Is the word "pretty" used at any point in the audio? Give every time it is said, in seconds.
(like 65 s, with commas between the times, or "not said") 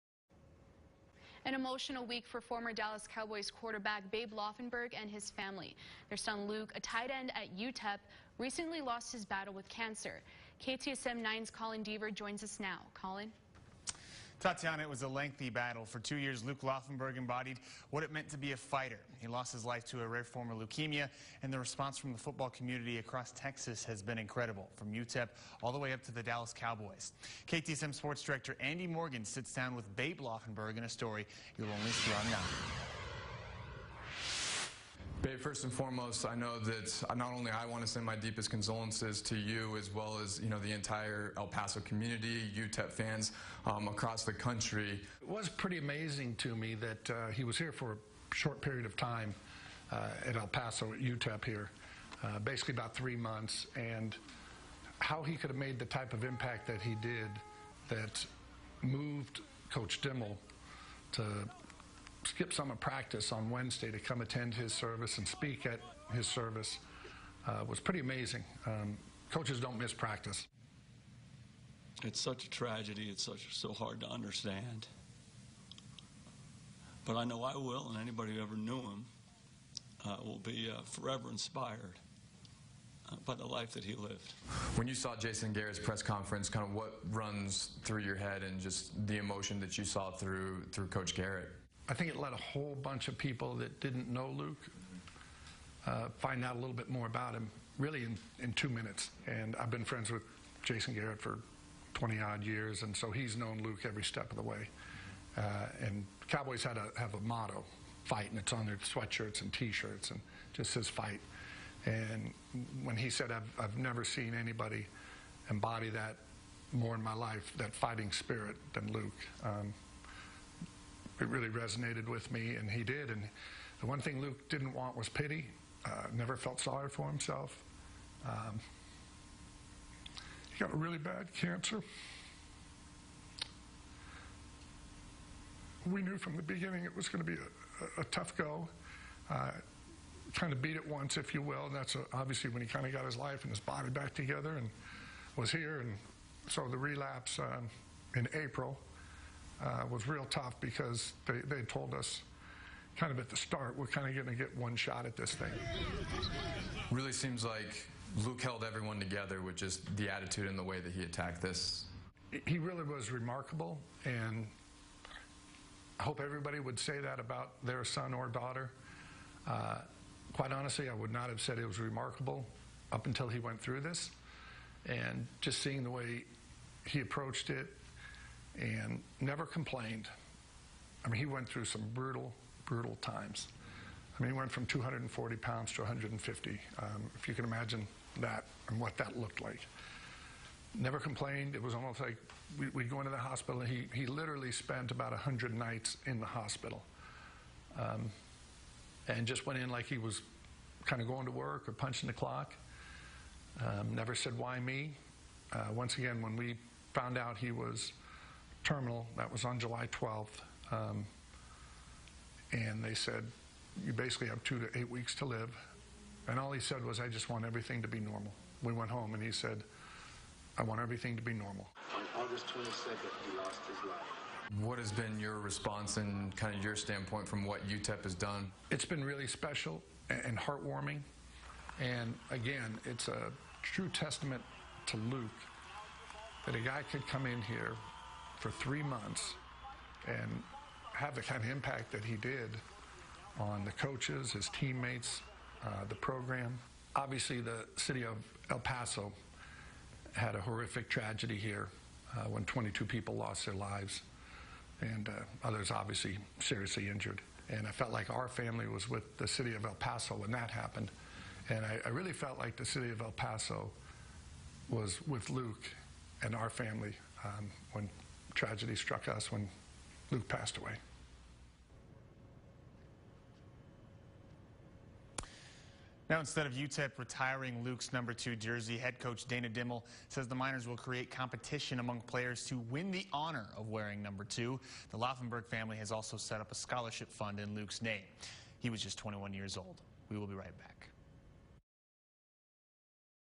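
45 s, 67 s.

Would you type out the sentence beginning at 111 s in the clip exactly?
And when he said, I've, I've never seen anybody embody that more in my life, that fighting spirit, than Luke.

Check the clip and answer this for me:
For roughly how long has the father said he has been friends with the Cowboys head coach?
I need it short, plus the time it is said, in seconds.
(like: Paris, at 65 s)
20 odd years, at 101 s.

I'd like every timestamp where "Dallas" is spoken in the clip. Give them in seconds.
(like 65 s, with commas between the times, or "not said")
2 s, 26 s.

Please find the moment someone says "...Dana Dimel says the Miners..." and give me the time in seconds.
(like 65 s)
279 s.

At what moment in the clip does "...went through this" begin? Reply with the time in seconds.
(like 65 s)
173 s.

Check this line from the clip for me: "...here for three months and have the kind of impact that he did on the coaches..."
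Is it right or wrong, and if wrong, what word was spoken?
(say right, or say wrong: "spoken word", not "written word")
right.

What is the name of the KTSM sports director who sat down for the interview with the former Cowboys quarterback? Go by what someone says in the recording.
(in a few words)
Andy Morgan.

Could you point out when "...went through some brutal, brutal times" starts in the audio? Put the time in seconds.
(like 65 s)
181 s.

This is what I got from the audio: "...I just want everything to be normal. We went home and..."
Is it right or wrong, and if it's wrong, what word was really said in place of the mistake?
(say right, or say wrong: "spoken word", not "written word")
right.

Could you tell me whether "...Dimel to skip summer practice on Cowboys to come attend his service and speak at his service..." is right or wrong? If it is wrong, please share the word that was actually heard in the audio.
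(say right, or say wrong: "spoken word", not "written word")
wrong: "Wednesday", not "Cowboys".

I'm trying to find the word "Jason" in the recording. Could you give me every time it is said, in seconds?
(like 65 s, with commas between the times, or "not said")
85 s, 100 s.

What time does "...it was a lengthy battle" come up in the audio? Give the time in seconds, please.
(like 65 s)
14 s.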